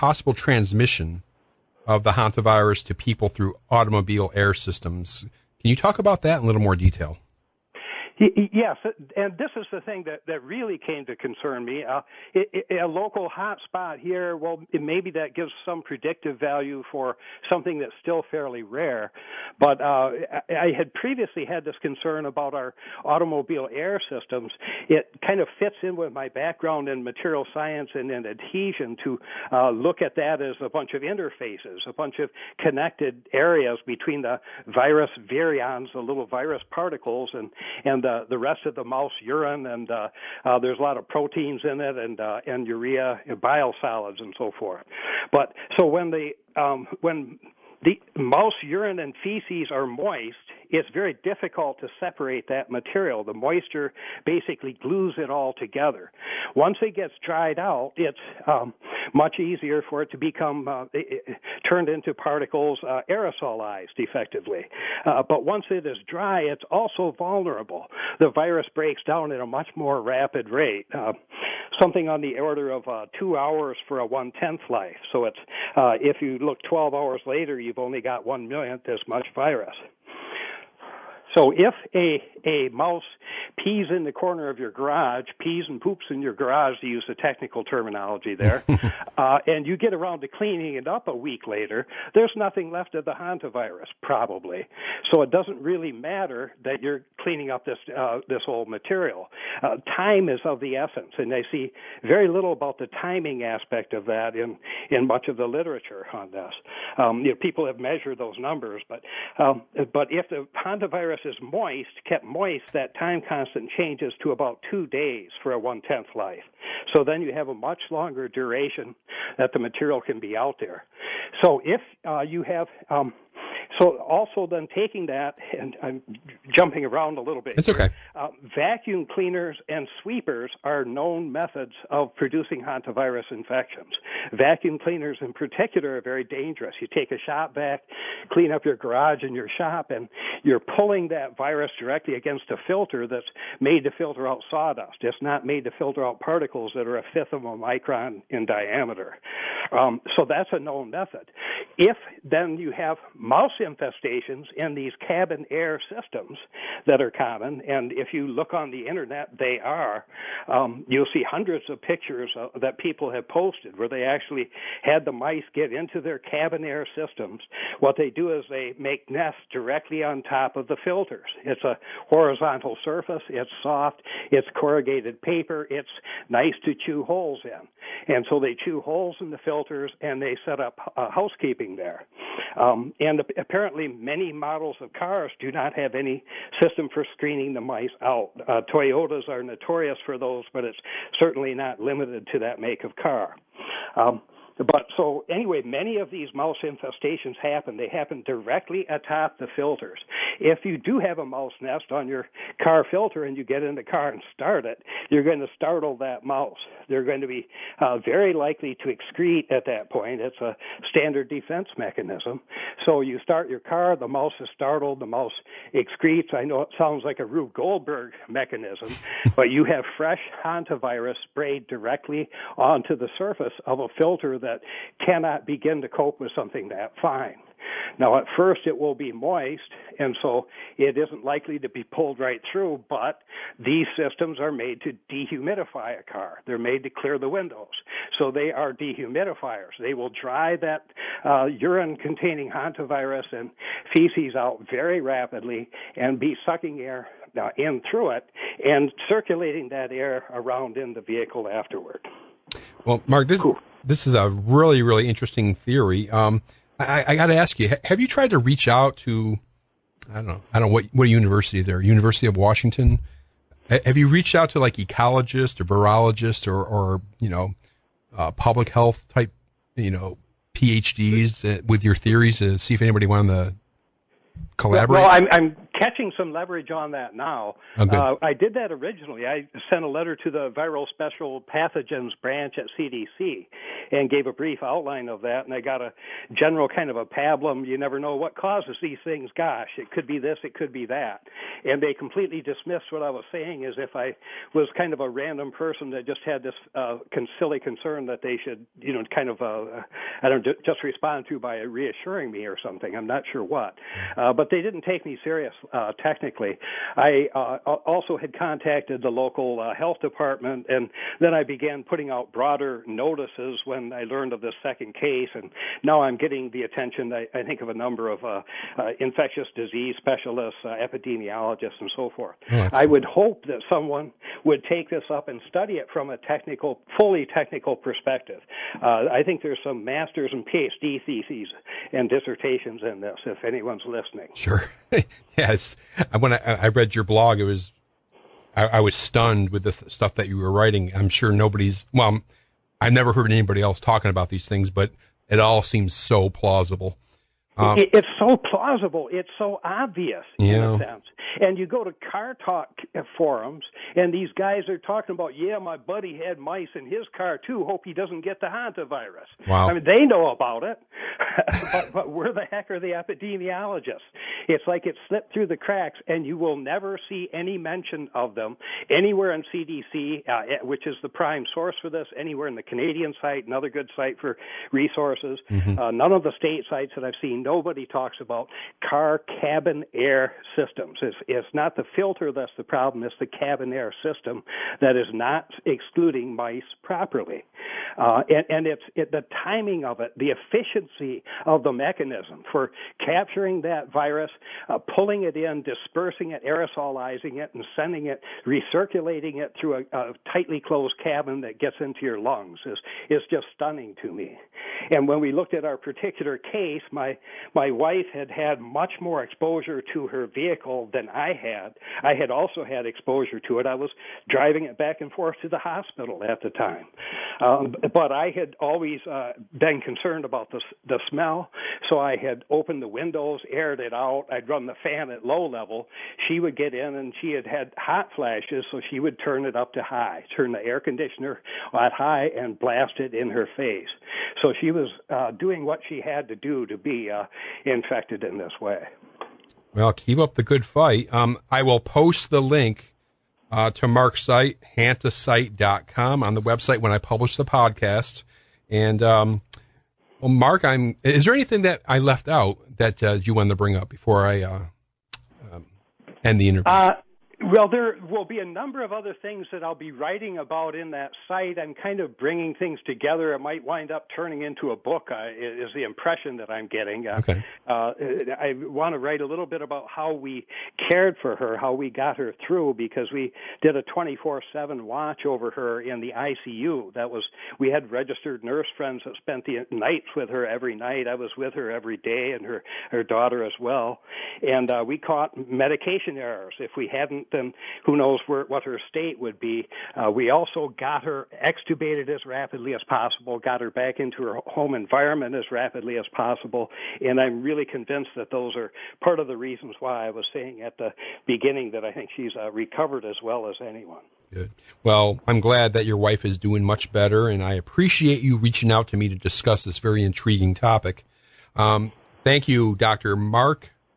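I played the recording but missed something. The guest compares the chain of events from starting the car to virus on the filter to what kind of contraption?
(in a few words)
Rube Goldberg mechanism.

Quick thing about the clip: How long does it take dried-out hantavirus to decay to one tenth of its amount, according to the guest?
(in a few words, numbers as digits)
2 hours.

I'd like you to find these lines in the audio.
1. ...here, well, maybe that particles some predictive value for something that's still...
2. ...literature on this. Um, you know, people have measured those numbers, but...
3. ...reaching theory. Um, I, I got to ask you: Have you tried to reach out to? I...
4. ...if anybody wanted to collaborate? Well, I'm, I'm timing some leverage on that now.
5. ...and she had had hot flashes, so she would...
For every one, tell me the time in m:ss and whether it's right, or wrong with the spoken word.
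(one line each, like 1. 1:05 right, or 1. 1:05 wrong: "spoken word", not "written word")
1. 0:13 wrong: "gives", not "particles"
2. 1:45 right
3. 4:15 wrong: "interesting", not "reaching"
4. 4:32 wrong: "catching", not "timing"
5. 7:06 right.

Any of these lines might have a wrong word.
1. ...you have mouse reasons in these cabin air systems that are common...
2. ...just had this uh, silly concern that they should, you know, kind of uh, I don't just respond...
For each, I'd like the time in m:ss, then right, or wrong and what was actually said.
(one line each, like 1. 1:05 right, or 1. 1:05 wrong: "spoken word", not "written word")
1. 2:32 wrong: "infestations", not "reasons"
2. 4:56 right.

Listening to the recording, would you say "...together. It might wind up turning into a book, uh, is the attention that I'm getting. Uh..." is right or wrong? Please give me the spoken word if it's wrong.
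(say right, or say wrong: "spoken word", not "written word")
wrong: "impression", not "attention".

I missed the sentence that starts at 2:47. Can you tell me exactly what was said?
What they do is they make nests directly on top of the filters.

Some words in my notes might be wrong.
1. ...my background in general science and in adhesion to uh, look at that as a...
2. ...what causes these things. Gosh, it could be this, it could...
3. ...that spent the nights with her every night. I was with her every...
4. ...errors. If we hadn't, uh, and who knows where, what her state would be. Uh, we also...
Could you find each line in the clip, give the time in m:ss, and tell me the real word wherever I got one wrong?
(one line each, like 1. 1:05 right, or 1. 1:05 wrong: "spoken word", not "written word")
1. 0:26 wrong: "material", not "general"
2. 4:48 right
3. 7:59 right
4. 8:06 right.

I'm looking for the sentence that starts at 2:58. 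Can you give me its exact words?
And so they chew holes in the filters and they set up uh, housekeeping sleeping there.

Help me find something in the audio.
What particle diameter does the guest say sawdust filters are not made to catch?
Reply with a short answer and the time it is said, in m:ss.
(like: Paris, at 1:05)
a fifth of a micron, at 2:26.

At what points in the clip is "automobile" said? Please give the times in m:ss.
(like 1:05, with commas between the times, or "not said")
0:03, 0:23.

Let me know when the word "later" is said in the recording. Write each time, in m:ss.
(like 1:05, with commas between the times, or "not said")
1:17, 1:31.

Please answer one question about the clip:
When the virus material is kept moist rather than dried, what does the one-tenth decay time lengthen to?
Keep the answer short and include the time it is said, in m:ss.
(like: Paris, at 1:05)
2 days, at 1:54.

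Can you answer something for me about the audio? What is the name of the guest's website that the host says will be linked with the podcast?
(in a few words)
hantasite.com.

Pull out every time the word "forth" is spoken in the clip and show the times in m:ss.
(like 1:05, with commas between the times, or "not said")
0:44, 5:22, 6:55.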